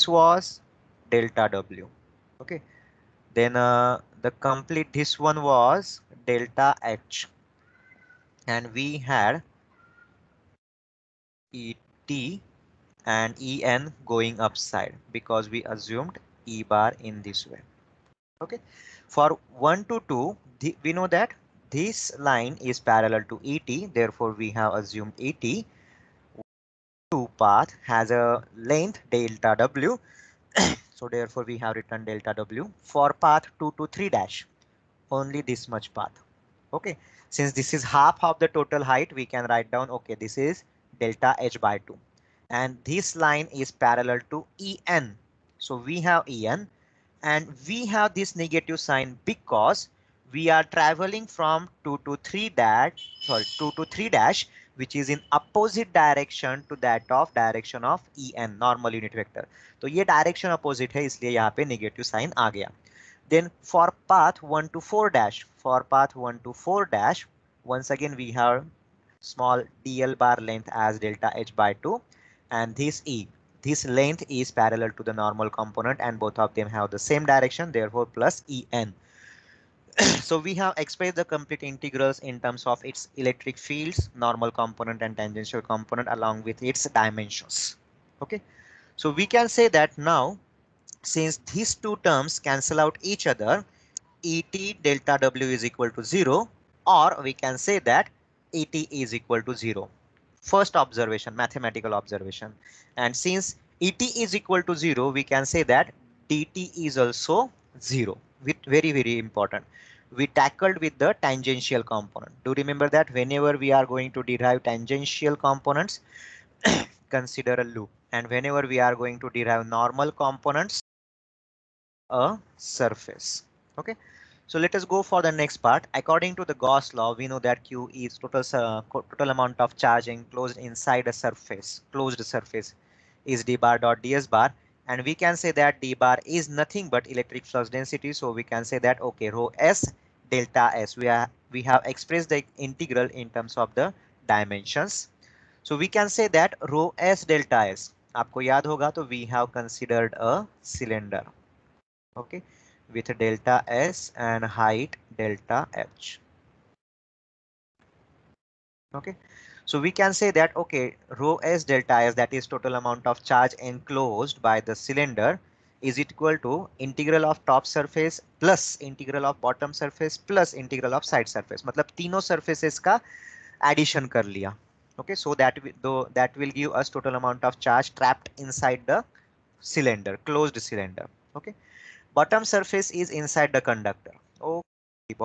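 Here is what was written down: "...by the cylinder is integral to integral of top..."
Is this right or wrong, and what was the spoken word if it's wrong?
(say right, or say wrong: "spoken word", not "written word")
wrong: "equal", not "integral".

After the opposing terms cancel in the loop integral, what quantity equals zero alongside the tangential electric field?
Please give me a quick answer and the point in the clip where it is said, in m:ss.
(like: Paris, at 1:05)
DT, at 1:46.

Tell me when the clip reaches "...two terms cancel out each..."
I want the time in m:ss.
1:31.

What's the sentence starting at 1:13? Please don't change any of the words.
This length is parallel to the normal component and both of them have the same direction therefore plus EN.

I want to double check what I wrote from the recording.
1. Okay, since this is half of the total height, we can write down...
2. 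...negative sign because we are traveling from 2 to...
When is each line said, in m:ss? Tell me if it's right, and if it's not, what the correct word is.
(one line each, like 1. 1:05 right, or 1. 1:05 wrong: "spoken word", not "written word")
1. 0:36 right
2. 0:48 right.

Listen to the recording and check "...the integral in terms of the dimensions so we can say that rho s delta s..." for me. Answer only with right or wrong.
right.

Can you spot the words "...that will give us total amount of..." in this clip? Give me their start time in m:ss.
2:56.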